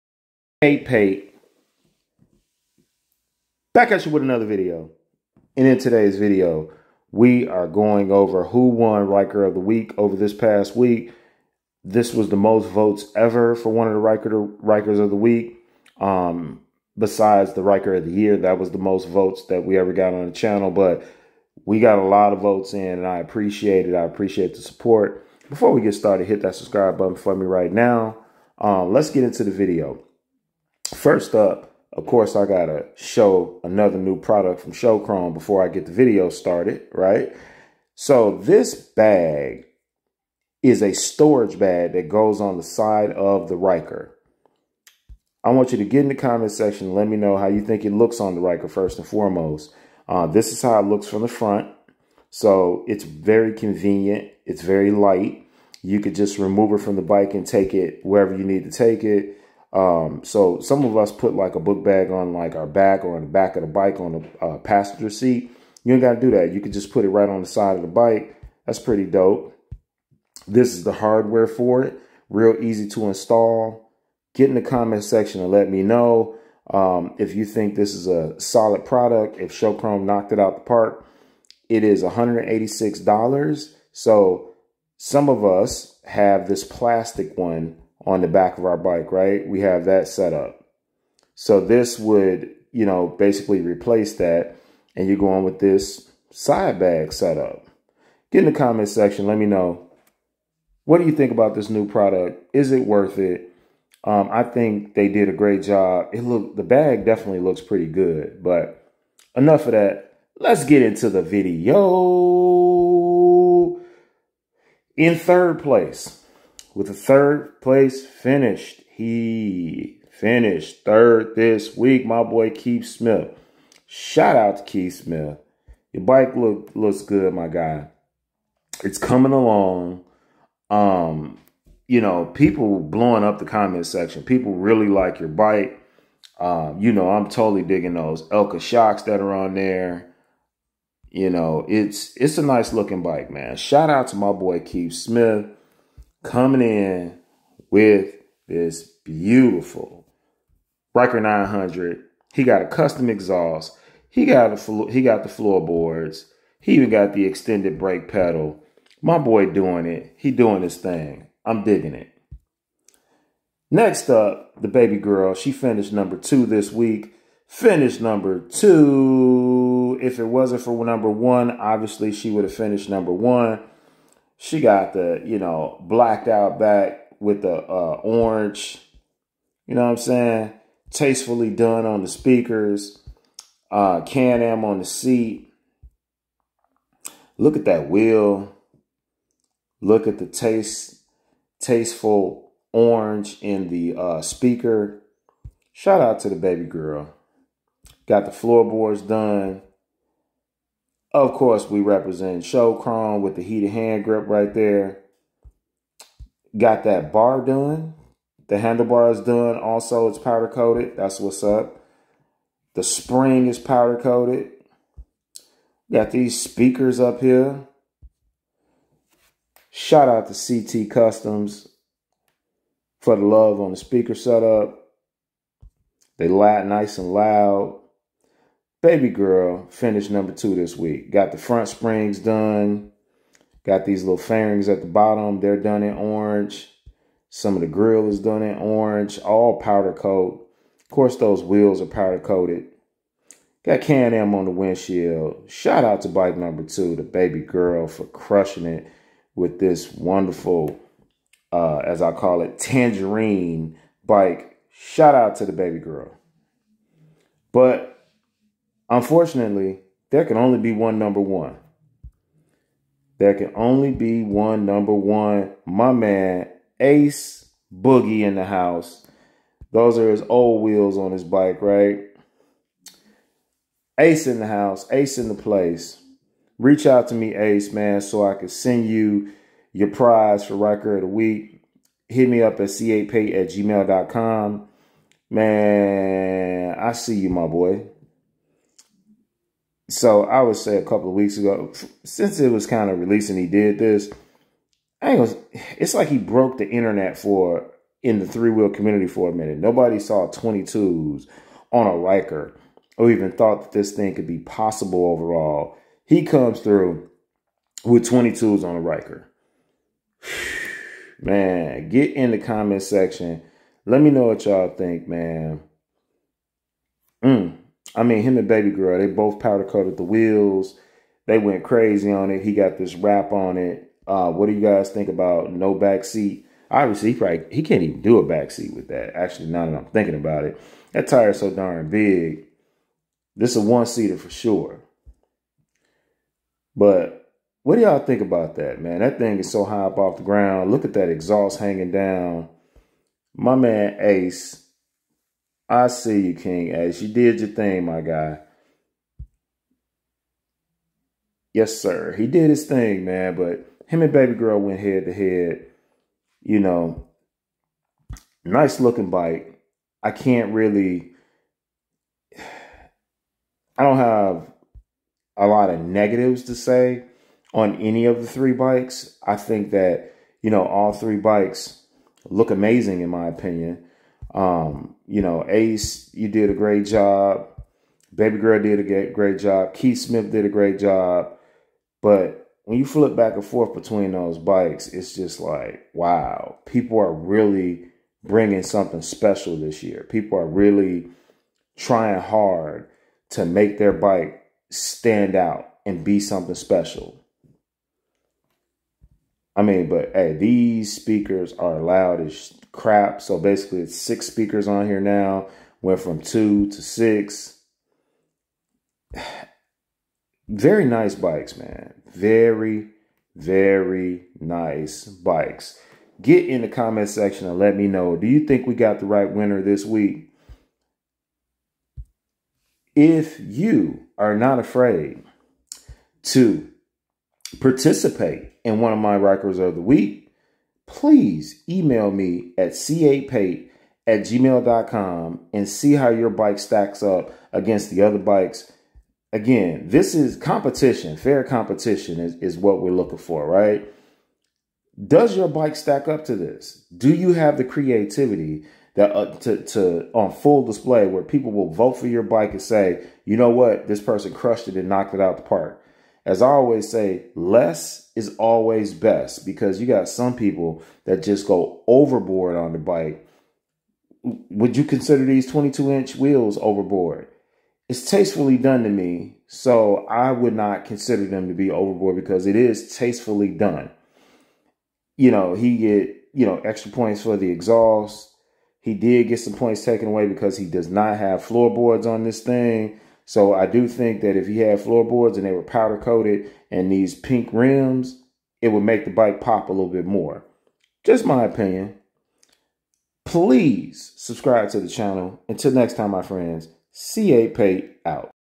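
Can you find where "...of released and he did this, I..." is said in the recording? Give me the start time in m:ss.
4:52.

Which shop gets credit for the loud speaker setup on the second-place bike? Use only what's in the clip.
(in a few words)
CT Customs.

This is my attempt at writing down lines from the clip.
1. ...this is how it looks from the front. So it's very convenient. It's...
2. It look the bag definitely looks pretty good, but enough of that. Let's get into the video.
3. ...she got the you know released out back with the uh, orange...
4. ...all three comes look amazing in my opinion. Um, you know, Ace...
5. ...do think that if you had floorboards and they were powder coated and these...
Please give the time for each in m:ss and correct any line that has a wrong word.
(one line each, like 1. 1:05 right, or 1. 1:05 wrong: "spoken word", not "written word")
1. 0:50 right
2. 1:46 right
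3. 2:54 wrong: "blacked", not "released"
4. 6:10 wrong: "bikes", not "comes"
5. 8:03 right.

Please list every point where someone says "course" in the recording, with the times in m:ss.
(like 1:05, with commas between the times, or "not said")
0:32, 3:21, 4:00.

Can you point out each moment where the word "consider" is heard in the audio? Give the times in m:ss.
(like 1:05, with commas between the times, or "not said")
7:44, 7:50.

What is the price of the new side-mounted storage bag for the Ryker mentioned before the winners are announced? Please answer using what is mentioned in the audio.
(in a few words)
$186.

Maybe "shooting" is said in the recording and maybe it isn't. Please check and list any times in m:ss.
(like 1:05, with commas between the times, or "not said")
not said.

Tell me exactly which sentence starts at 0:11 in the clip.
This was the most votes ever for one of the Ryker, Rykers of the Week.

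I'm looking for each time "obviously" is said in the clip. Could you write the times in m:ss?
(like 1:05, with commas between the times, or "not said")
2:51, 5:26.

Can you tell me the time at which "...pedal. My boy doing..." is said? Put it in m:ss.
2:38.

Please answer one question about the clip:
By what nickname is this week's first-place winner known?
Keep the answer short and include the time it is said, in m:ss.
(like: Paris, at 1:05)
Ace Boogie, at 4:26.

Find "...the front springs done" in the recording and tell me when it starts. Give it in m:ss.
3:51.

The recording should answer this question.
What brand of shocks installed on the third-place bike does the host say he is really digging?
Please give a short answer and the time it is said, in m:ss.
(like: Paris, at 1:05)
Elka, at 2:18.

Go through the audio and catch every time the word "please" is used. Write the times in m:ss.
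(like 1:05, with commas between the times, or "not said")
7:10, 8:13.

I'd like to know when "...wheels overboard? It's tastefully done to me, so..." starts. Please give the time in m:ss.
7:46.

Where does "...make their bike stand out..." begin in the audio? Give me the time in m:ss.
6:33.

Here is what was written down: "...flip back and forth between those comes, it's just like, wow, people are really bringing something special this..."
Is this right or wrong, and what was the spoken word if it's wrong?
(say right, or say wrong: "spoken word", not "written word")
wrong: "bikes", not "comes".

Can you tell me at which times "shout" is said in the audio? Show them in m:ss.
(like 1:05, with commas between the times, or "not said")
2:03, 2:23, 3:15, 3:39, 4:05, 4:14.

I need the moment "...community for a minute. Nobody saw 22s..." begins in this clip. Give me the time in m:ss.
4:58.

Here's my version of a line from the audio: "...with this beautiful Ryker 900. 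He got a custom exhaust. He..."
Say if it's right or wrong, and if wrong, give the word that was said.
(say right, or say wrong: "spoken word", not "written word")
right.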